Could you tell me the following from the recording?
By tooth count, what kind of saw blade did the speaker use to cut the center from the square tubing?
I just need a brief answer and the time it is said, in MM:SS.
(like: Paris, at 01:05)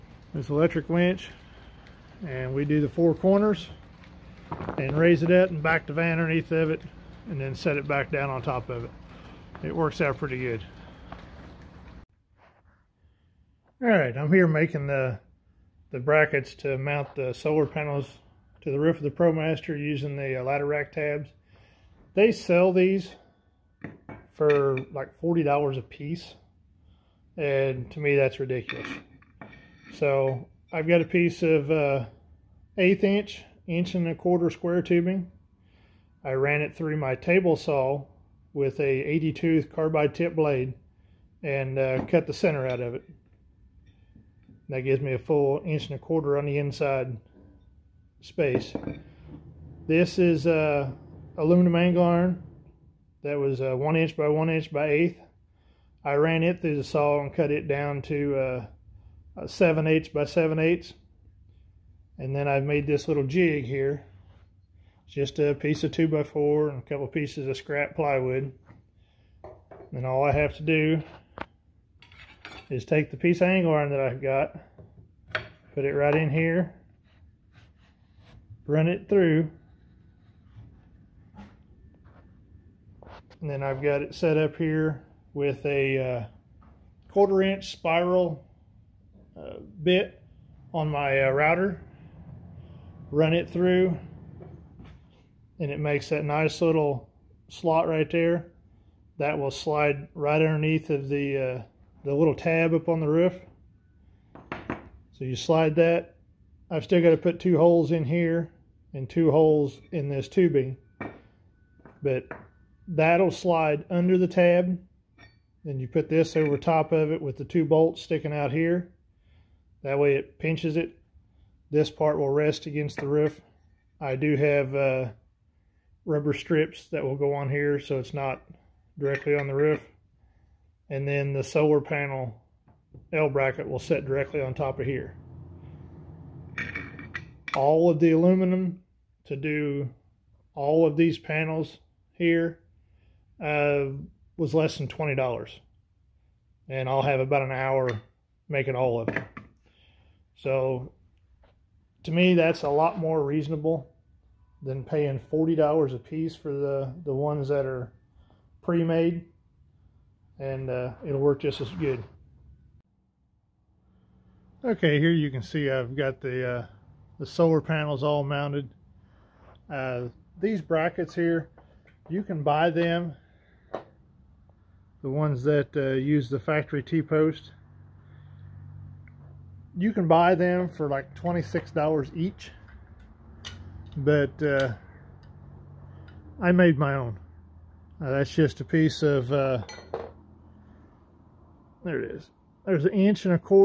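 80 tooth carbide, at 00:39.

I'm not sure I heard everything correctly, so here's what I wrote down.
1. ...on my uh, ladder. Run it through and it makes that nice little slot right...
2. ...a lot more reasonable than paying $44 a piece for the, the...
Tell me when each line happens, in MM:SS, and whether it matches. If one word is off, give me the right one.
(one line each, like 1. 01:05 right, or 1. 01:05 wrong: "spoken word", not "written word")
1. 01:30 wrong: "router", not "ladder"
2. 02:32 wrong: "40", not "44".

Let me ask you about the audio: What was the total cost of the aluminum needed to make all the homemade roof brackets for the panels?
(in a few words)
less than $20.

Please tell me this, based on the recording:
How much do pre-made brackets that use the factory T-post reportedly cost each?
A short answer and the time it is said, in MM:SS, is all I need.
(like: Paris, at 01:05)
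$26, at 03:01.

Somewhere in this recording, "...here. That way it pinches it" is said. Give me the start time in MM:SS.
01:58.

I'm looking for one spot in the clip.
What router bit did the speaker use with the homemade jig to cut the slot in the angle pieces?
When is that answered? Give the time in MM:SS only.
01:27.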